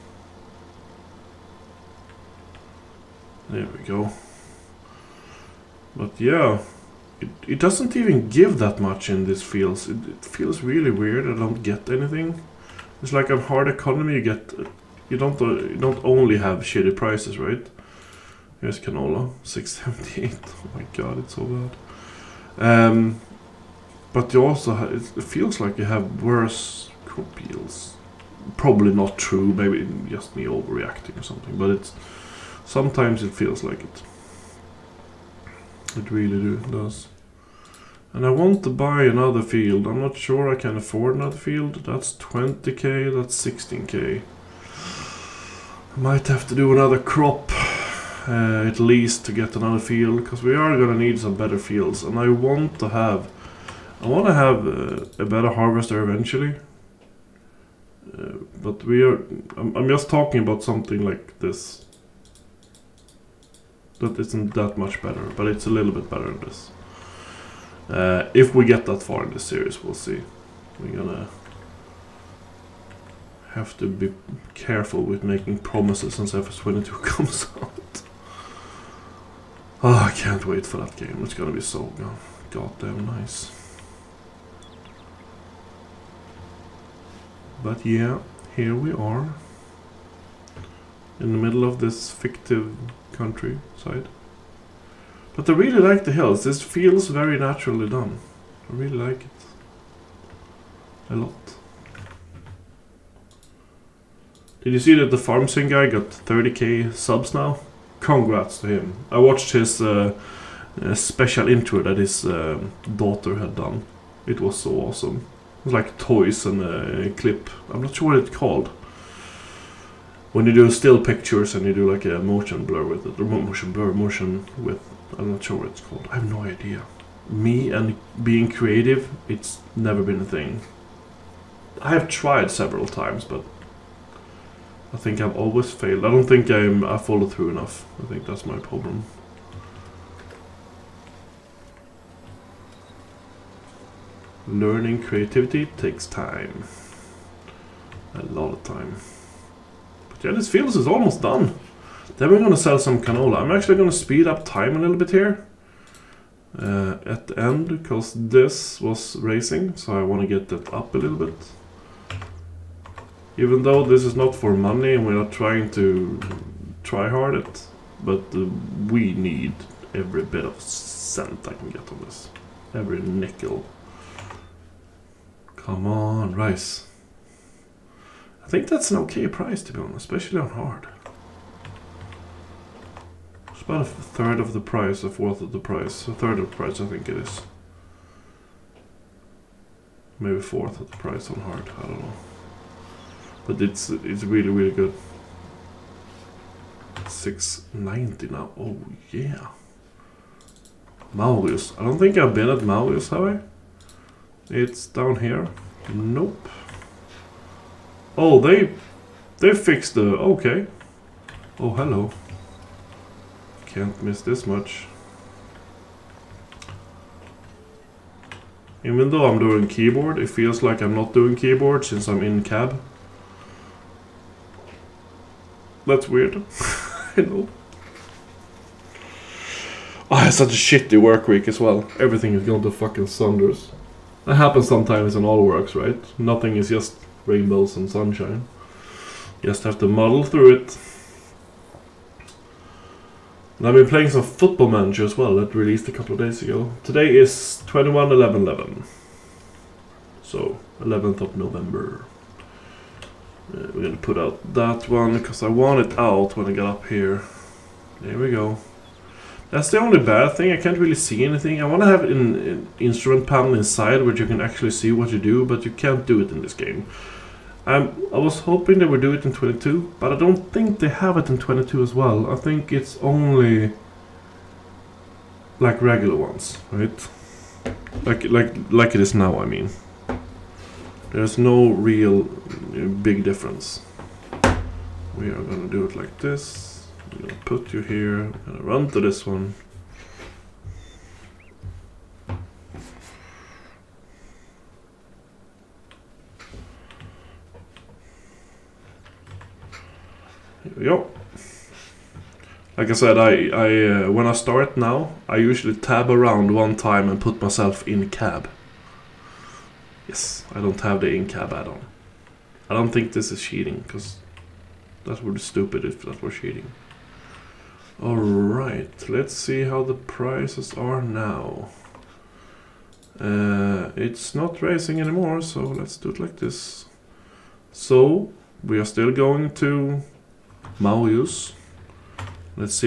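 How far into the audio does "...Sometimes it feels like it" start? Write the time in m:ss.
0:32.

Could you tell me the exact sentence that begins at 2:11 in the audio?
I have tried several times, but I think I've always failed.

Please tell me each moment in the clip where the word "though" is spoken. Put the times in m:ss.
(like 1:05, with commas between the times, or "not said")
2:43, 3:39.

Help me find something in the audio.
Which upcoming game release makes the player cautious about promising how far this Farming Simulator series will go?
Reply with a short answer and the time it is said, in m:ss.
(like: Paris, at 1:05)
FS22, at 1:16.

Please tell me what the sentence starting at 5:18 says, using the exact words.
Alright, let's see how the prices are now.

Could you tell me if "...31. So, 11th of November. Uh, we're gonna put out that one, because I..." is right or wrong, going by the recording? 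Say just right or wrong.
wrong.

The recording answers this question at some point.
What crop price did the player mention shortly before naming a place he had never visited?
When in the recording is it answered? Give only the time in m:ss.
3:17.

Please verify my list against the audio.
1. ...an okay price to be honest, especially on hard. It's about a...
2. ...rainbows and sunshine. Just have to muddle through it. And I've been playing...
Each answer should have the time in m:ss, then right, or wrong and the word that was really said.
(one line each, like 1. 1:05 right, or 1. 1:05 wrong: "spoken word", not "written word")
1. 2:58 right
2. 3:57 right.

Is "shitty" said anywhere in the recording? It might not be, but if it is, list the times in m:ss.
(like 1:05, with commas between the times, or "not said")
0:16, 3:50.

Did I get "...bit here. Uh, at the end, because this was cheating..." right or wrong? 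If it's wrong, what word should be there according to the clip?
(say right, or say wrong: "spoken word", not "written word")
wrong: "racing", not "cheating".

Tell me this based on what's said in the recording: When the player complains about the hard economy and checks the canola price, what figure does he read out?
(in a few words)
678.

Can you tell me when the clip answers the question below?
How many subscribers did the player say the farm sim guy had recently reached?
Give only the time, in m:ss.
1:46.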